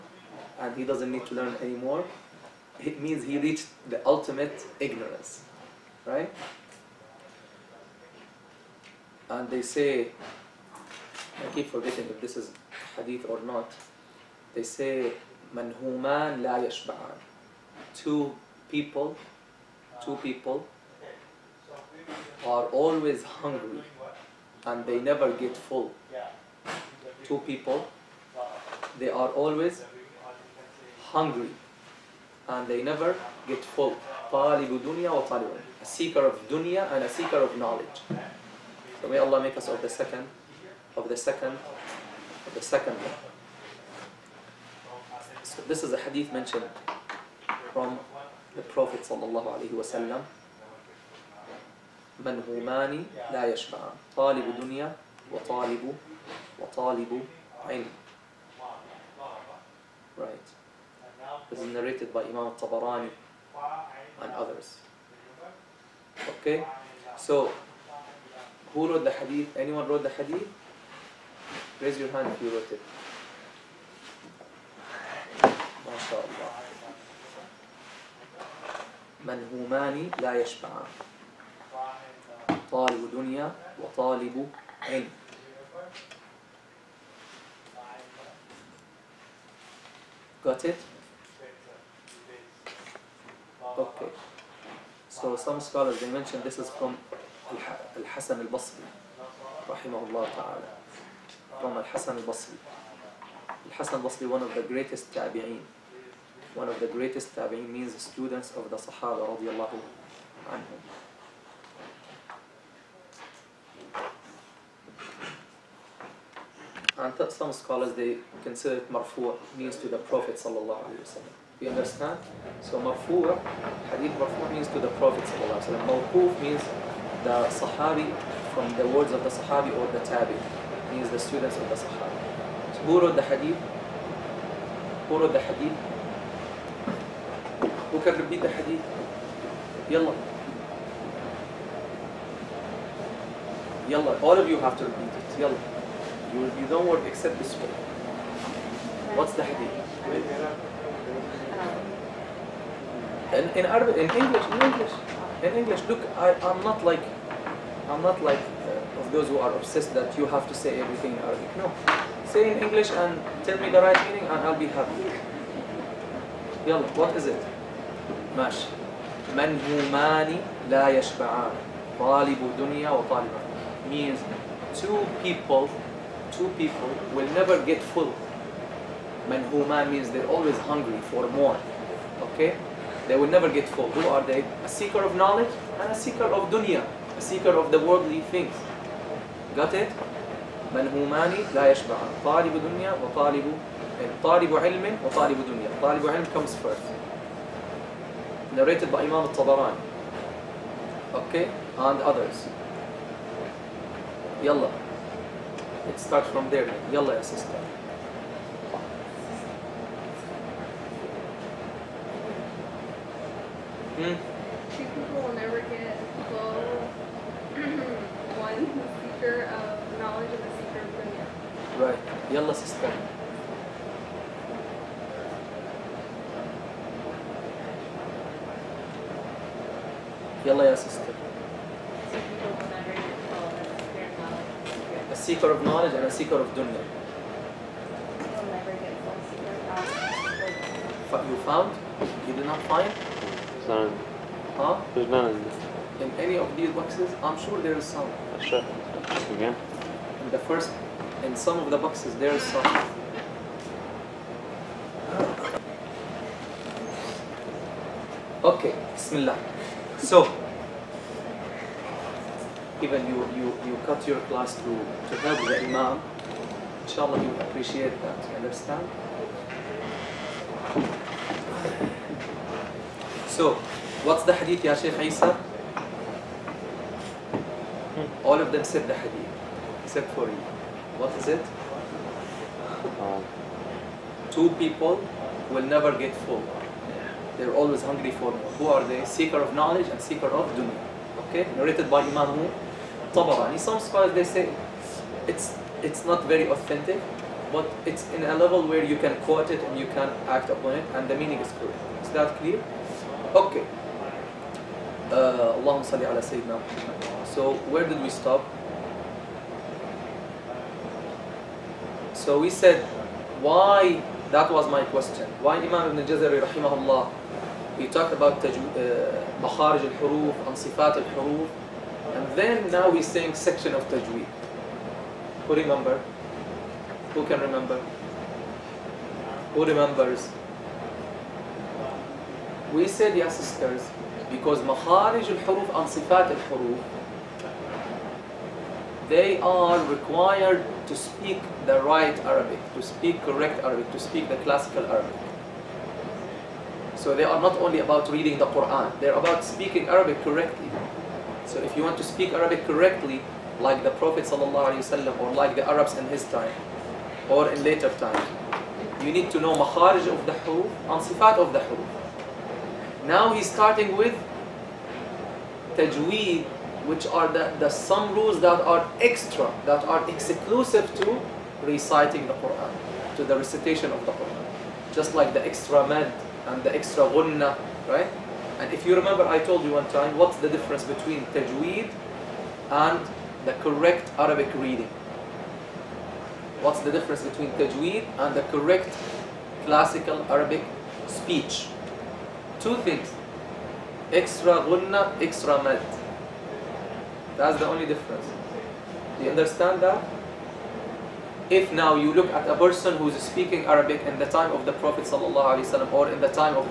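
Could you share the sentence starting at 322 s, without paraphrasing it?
And then now we saying section of Tajweed.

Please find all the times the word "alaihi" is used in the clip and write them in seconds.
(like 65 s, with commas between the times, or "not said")
49 s, 120 s, 125 s.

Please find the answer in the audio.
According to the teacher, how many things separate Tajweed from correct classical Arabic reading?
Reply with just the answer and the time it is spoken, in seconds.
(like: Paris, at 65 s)
2, at 392 s.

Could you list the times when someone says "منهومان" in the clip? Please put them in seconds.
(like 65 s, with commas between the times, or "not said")
52 s, 191 s.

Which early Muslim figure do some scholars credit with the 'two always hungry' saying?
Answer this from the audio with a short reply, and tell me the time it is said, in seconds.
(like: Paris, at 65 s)
Al Hassan Al Basri, at 102 s.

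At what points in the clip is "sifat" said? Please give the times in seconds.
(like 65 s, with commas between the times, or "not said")
335 s, 361 s.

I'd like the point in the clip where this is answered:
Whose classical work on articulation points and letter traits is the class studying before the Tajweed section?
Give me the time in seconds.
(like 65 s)
315 s.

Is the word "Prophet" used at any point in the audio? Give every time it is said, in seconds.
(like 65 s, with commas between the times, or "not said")
48 s, 119 s, 125 s, 353 s, 404 s.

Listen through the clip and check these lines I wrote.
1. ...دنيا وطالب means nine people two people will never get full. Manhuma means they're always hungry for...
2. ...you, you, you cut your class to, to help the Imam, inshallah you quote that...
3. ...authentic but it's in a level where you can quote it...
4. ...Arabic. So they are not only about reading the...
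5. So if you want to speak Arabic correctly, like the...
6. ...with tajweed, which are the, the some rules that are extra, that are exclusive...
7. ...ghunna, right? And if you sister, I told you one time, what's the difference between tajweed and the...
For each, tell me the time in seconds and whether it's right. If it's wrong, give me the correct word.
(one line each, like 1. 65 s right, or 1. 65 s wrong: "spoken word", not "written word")
1. 172 s wrong: "two", not "nine"
2. 263 s wrong: "appreciate", not "quote"
3. 296 s right
4. 344 s right
5. 351 s right
6. 363 s right
7. 377 s wrong: "remember", not "sister".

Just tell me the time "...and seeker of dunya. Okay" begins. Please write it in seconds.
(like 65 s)
289 s.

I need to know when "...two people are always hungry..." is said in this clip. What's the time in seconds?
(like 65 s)
20 s.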